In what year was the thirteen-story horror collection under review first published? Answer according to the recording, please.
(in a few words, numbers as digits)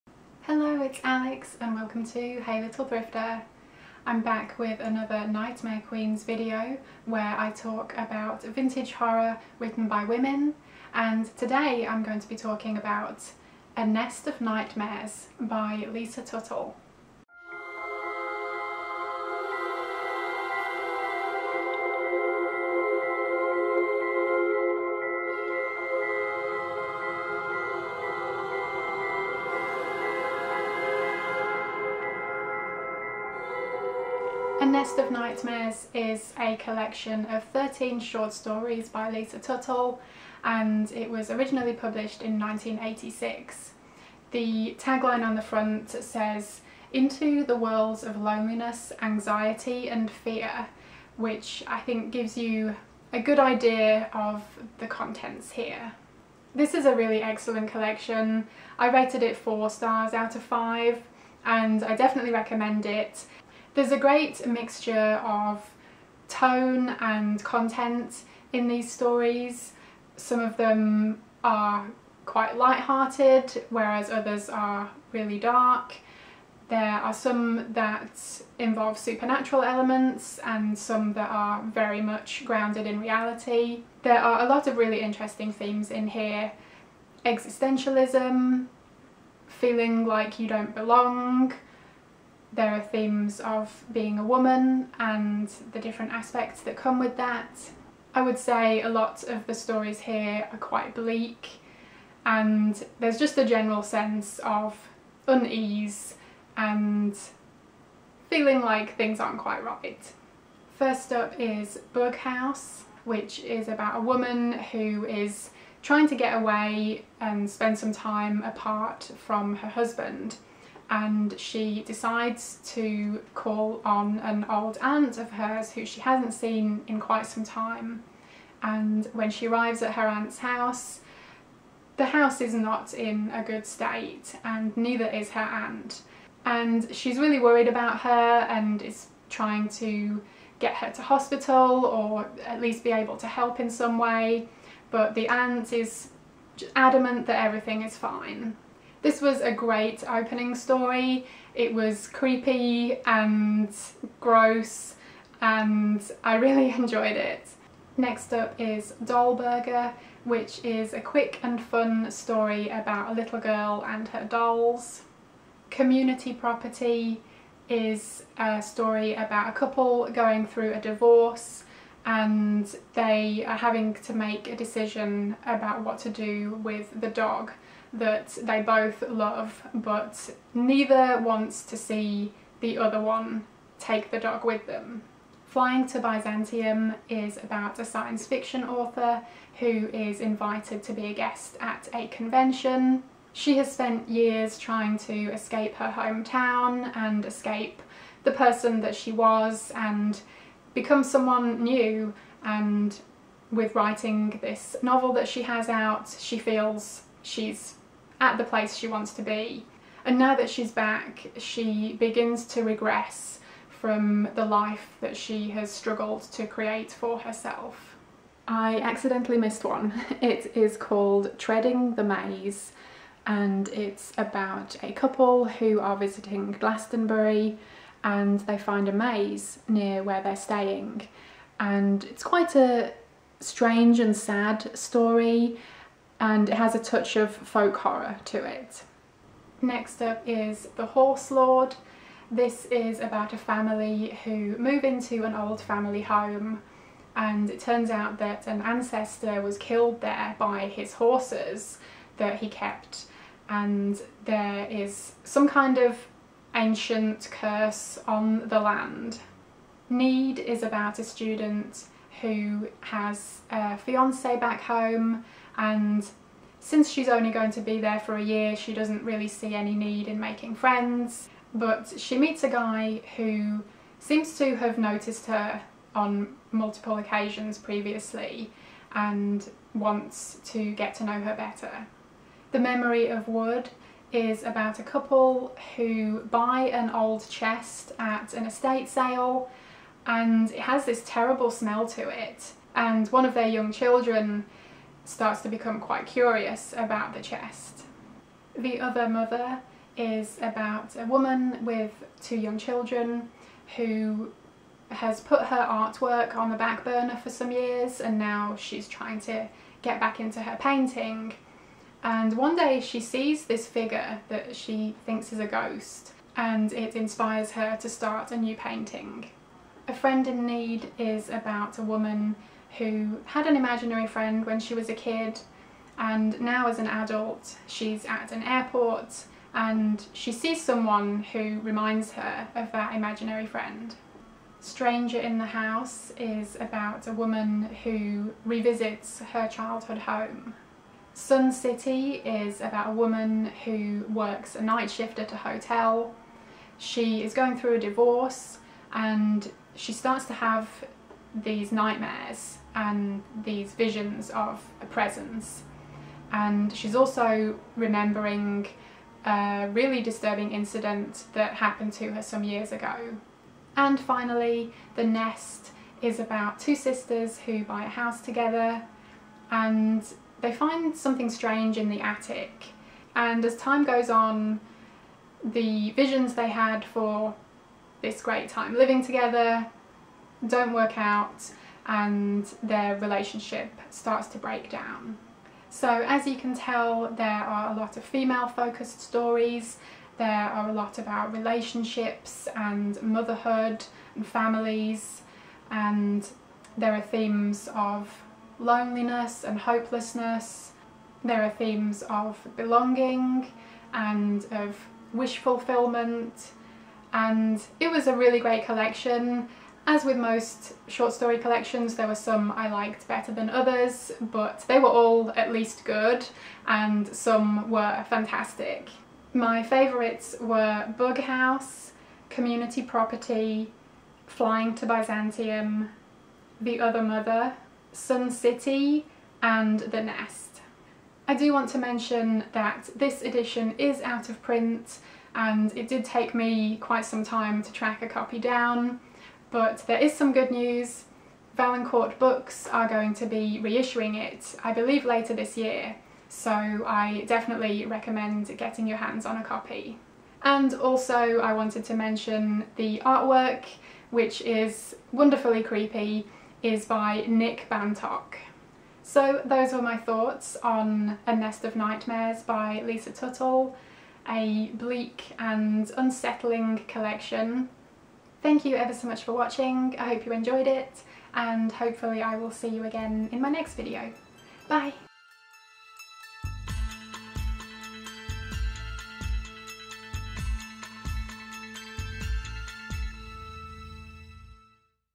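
1986.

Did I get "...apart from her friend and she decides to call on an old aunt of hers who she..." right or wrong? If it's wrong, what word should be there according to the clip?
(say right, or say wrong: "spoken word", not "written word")
wrong: "husband", not "friend".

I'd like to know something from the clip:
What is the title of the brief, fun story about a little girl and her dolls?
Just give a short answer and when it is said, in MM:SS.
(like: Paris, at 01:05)
Dollburger, at 02:39.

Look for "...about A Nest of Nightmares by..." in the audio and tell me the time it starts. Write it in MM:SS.
00:12.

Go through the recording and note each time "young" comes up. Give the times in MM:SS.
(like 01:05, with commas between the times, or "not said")
04:53, 05:02.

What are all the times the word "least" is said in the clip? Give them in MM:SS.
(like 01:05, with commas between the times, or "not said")
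02:22, 06:55.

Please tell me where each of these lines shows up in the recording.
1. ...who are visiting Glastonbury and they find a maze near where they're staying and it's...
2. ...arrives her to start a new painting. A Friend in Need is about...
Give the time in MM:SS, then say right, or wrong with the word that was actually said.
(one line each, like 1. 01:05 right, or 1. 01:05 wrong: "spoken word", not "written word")
1. 03:45 right
2. 05:16 wrong: "inspires", not "arrives".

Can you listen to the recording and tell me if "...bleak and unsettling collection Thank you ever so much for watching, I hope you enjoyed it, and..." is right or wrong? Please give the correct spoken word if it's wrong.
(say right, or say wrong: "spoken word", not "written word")
right.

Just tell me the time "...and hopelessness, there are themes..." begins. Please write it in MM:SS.
06:39.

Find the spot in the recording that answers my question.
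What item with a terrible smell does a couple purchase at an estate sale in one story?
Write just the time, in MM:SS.
04:46.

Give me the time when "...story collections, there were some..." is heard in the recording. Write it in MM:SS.
06:51.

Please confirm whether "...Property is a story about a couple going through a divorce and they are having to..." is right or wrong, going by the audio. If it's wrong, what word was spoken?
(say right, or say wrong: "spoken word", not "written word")
right.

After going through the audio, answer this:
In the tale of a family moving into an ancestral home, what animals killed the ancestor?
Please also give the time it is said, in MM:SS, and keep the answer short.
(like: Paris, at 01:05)
His horses, at 04:10.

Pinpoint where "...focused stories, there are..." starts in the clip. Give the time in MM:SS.
06:28.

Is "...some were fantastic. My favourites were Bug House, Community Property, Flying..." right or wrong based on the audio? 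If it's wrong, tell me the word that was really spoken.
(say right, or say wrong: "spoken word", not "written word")
right.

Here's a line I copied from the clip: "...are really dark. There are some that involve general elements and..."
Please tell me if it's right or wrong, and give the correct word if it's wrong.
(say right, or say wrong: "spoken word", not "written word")
wrong: "supernatural", not "general".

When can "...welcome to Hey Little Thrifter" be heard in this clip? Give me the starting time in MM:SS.
00:01.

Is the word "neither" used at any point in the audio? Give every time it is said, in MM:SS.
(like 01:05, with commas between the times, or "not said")
02:14, 03:00.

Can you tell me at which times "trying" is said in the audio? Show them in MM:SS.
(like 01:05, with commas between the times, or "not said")
01:55, 02:19, 03:14, 05:08.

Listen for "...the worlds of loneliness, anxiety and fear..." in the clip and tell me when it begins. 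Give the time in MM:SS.
00:47.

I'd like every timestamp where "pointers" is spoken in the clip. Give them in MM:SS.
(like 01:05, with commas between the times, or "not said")
not said.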